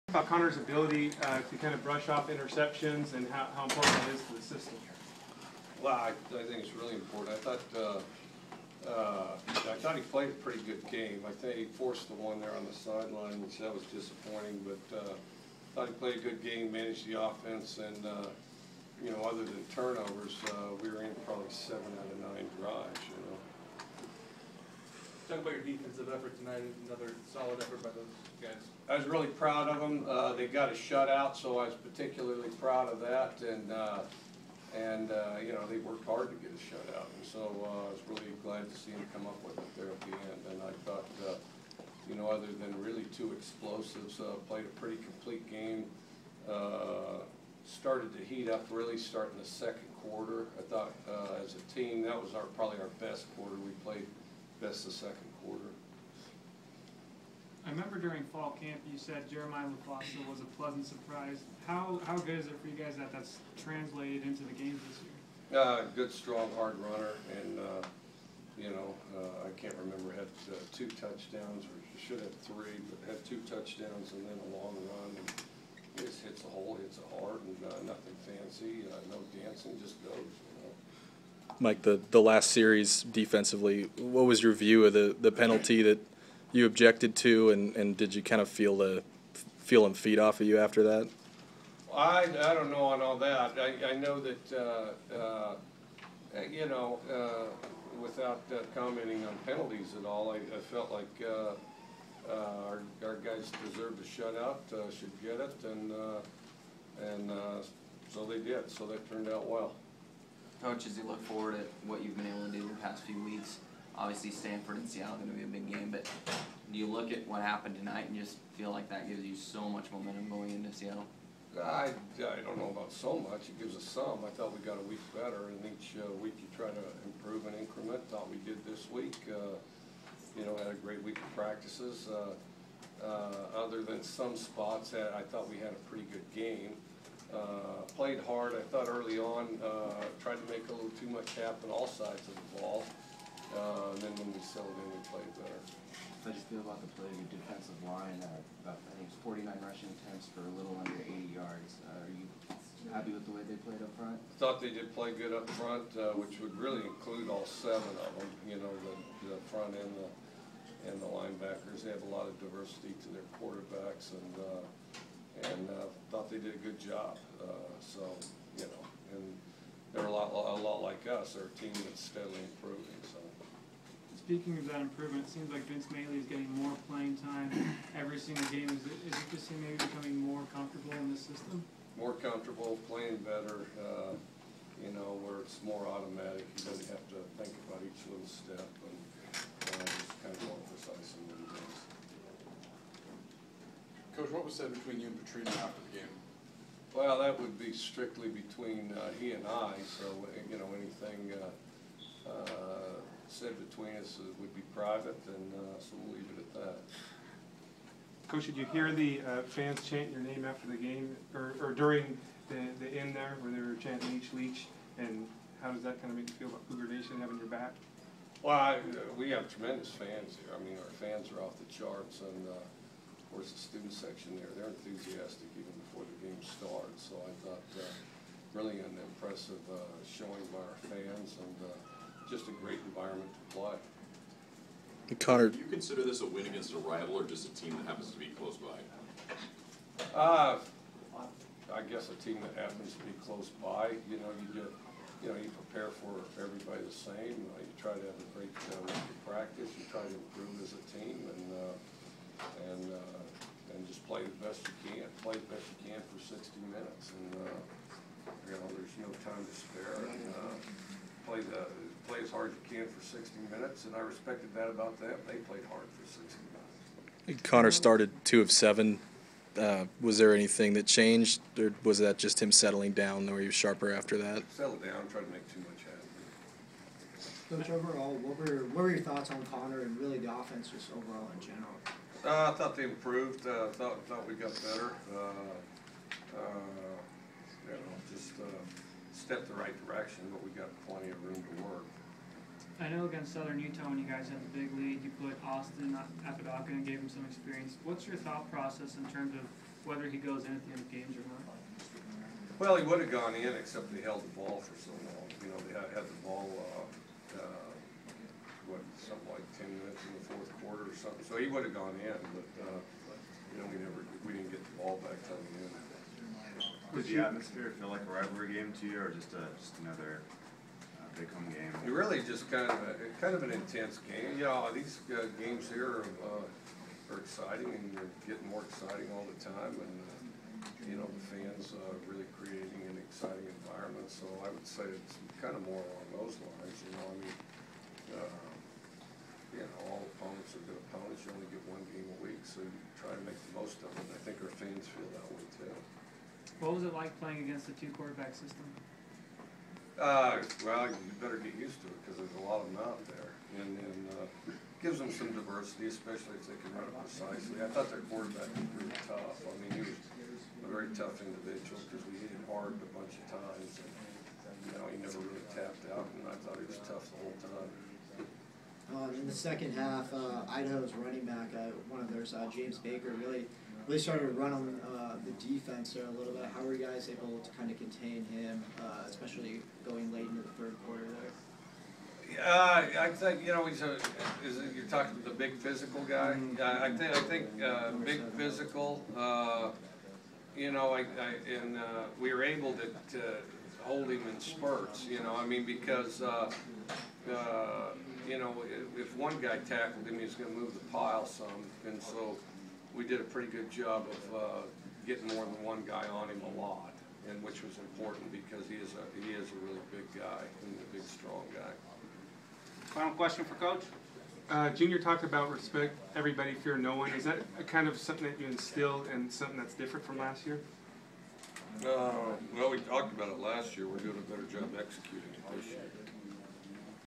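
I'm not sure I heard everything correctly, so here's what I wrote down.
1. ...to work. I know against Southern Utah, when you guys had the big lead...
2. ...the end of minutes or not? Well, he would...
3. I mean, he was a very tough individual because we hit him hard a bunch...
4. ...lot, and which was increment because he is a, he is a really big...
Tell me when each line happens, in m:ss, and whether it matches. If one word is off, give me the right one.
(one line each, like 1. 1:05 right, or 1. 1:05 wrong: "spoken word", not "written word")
1. 4:51 right
2. 5:00 wrong: "games", not "minutes"
3. 5:59 right
4. 6:46 wrong: "important", not "increment".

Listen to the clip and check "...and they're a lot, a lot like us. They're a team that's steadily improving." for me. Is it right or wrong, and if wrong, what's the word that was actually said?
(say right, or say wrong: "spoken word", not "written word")
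right.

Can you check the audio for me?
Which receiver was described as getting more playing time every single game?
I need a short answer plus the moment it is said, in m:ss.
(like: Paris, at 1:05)
Vince Mayle, at 2:55.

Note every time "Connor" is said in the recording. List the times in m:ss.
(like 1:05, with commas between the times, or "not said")
0:00, 3:55, 4:27, 4:39.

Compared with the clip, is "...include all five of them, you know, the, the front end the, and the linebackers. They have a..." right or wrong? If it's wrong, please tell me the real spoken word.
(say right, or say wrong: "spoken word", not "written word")
wrong: "seven", not "five".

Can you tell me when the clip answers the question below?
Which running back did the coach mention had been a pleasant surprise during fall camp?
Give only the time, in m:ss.
0:59.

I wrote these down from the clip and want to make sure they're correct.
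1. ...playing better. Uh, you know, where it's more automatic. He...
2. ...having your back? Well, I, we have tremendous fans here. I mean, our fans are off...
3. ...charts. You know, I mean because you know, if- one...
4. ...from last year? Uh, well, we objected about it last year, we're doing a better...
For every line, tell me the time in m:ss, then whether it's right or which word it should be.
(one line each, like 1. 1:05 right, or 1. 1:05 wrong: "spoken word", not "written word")
1. 3:02 right
2. 3:37 right
3. 6:34 wrong: "spurts", not "charts"
4. 7:00 wrong: "talked", not "objected".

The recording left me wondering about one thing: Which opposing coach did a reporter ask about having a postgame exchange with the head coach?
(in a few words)
Petrino.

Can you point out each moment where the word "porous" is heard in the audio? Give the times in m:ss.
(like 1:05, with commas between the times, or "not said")
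not said.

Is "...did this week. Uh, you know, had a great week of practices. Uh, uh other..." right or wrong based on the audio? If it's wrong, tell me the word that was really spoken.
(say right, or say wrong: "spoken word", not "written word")
right.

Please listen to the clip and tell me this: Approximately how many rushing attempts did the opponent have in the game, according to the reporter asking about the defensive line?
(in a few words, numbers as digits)
49.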